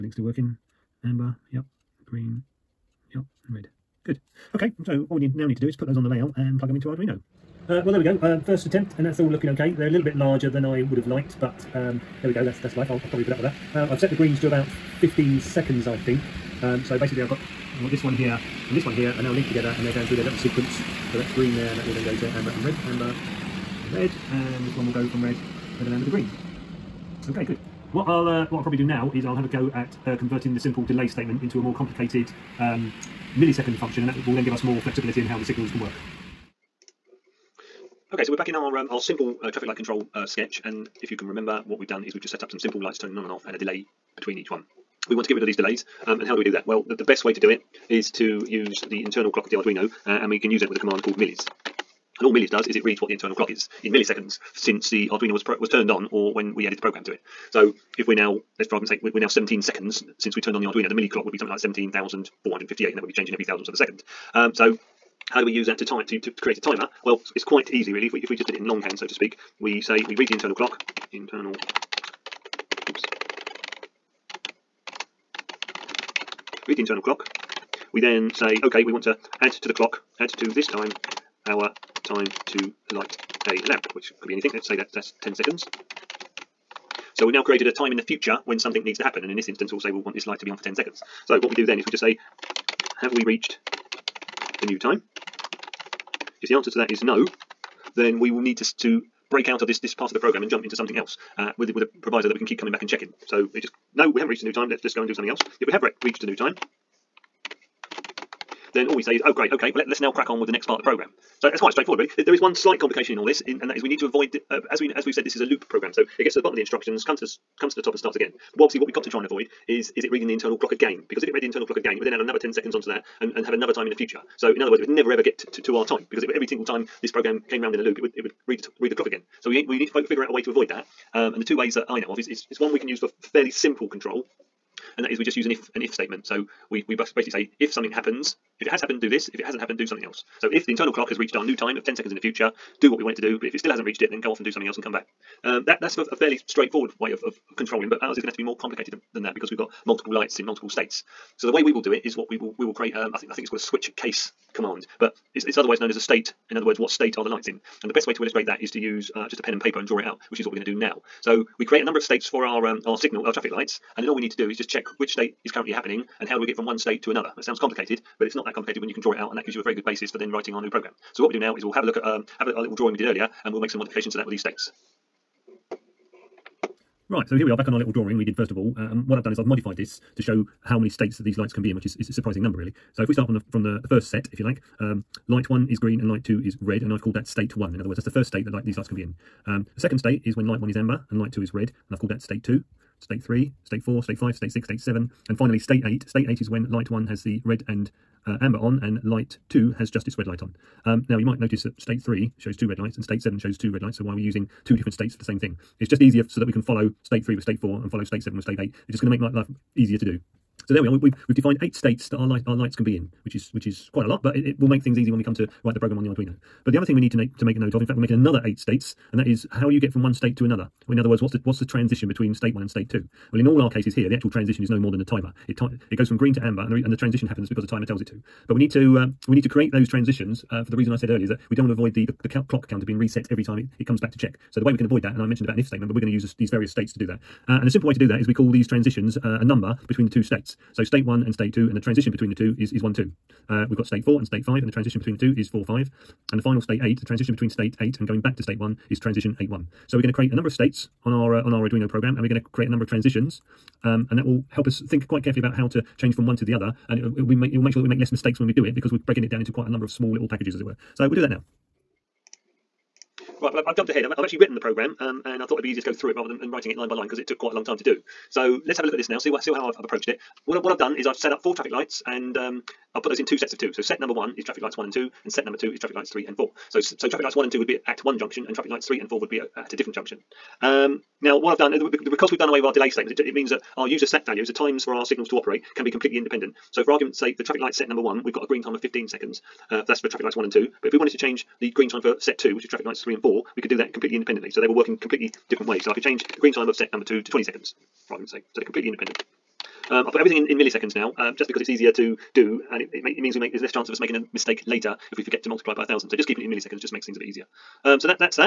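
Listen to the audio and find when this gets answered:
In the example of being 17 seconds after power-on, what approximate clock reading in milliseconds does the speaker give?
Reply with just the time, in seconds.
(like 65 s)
61 s.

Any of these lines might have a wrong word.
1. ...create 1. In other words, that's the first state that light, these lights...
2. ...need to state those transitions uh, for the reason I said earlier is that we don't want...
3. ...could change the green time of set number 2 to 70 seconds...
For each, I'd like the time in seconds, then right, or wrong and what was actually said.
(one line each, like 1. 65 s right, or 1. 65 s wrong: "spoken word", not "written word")
1. 187 s wrong: "state", not "create"
2. 229 s wrong: "create", not "state"
3. 295 s wrong: "20", not "70".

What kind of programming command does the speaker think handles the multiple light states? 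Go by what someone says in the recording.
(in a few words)
switch case.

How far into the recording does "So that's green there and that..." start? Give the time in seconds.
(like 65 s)
21 s.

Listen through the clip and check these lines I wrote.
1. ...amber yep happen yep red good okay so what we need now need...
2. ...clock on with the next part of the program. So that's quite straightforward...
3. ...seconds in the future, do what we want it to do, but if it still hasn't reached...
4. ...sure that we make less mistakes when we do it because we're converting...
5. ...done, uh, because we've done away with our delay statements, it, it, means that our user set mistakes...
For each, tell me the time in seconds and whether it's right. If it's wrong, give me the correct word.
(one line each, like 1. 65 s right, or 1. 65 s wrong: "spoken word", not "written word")
1. 1 s wrong: "green", not "happen"
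2. 110 s wrong: "crack", not "clock"
3. 141 s right
4. 257 s wrong: "breaking", not "converting"
5. 281 s wrong: "values", not "mistakes".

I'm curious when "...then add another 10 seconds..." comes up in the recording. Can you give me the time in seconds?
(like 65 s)
122 s.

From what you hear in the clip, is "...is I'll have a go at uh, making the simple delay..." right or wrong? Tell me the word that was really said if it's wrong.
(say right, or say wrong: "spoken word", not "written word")
wrong: "converting", not "making".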